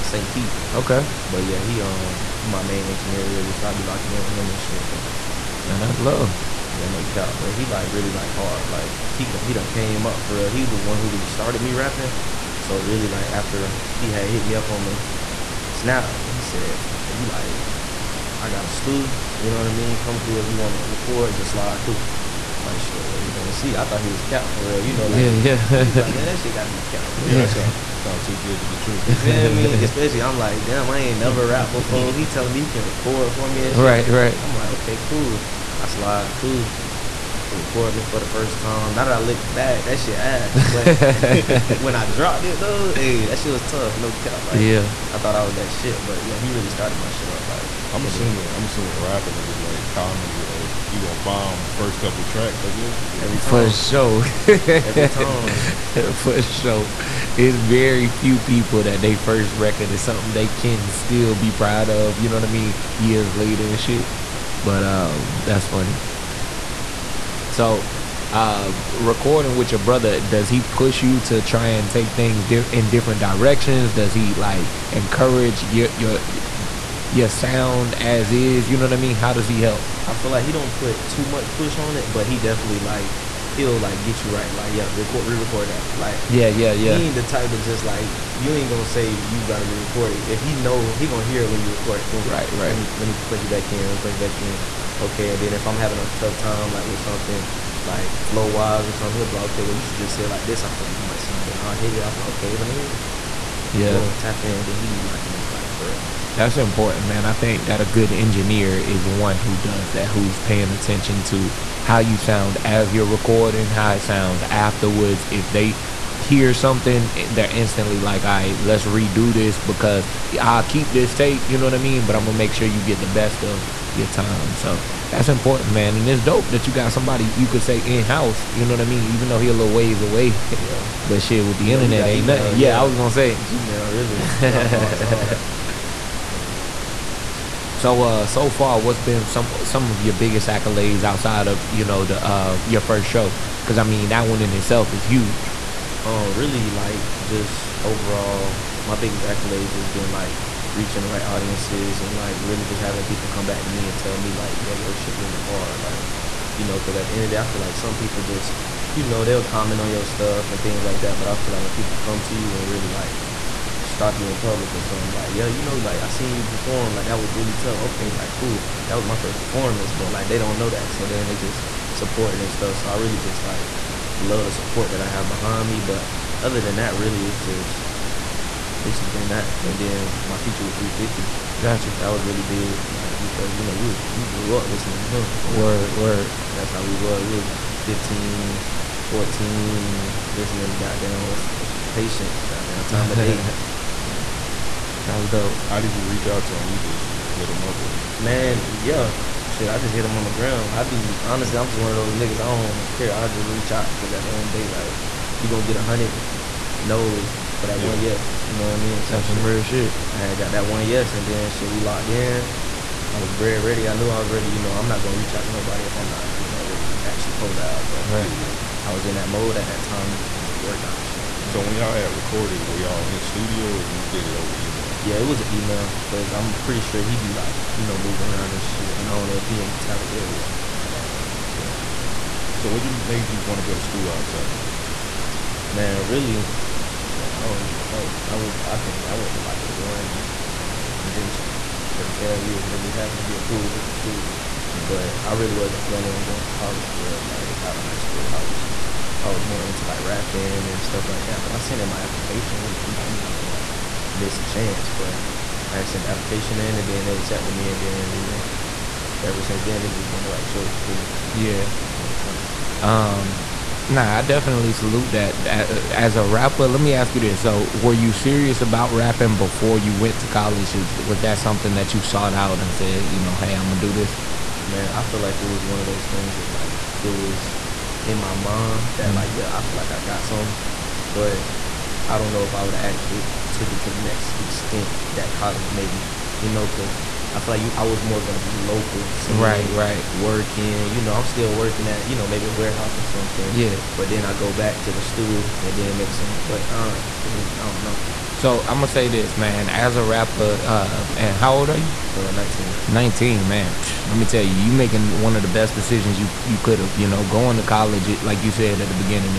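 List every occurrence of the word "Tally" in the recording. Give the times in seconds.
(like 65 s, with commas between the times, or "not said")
229 s, 234 s.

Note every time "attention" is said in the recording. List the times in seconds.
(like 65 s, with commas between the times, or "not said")
110 s.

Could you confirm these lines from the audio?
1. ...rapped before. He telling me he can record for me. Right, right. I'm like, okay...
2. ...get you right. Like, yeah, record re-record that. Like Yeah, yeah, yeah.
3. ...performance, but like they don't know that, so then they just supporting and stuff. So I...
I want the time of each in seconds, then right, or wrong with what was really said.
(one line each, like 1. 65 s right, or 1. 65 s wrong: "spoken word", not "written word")
1. 31 s right
2. 84 s right
3. 169 s right.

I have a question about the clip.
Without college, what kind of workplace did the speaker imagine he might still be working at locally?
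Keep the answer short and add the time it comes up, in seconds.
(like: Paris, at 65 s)
A warehouse, at 292 s.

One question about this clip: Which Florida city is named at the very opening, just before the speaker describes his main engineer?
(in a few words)
St. Pete.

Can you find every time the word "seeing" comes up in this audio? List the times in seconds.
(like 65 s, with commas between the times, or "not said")
289 s.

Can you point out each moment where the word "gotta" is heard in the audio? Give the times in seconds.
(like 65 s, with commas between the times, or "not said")
26 s, 89 s.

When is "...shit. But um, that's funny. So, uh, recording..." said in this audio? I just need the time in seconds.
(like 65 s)
63 s.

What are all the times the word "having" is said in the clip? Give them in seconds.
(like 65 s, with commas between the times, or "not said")
95 s, 152 s.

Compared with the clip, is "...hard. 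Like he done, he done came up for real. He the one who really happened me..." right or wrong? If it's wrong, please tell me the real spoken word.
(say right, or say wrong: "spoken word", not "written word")
wrong: "started", not "happened".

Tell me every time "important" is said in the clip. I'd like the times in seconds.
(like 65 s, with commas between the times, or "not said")
106 s, 125 s.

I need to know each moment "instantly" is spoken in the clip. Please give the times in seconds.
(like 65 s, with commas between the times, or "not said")
117 s.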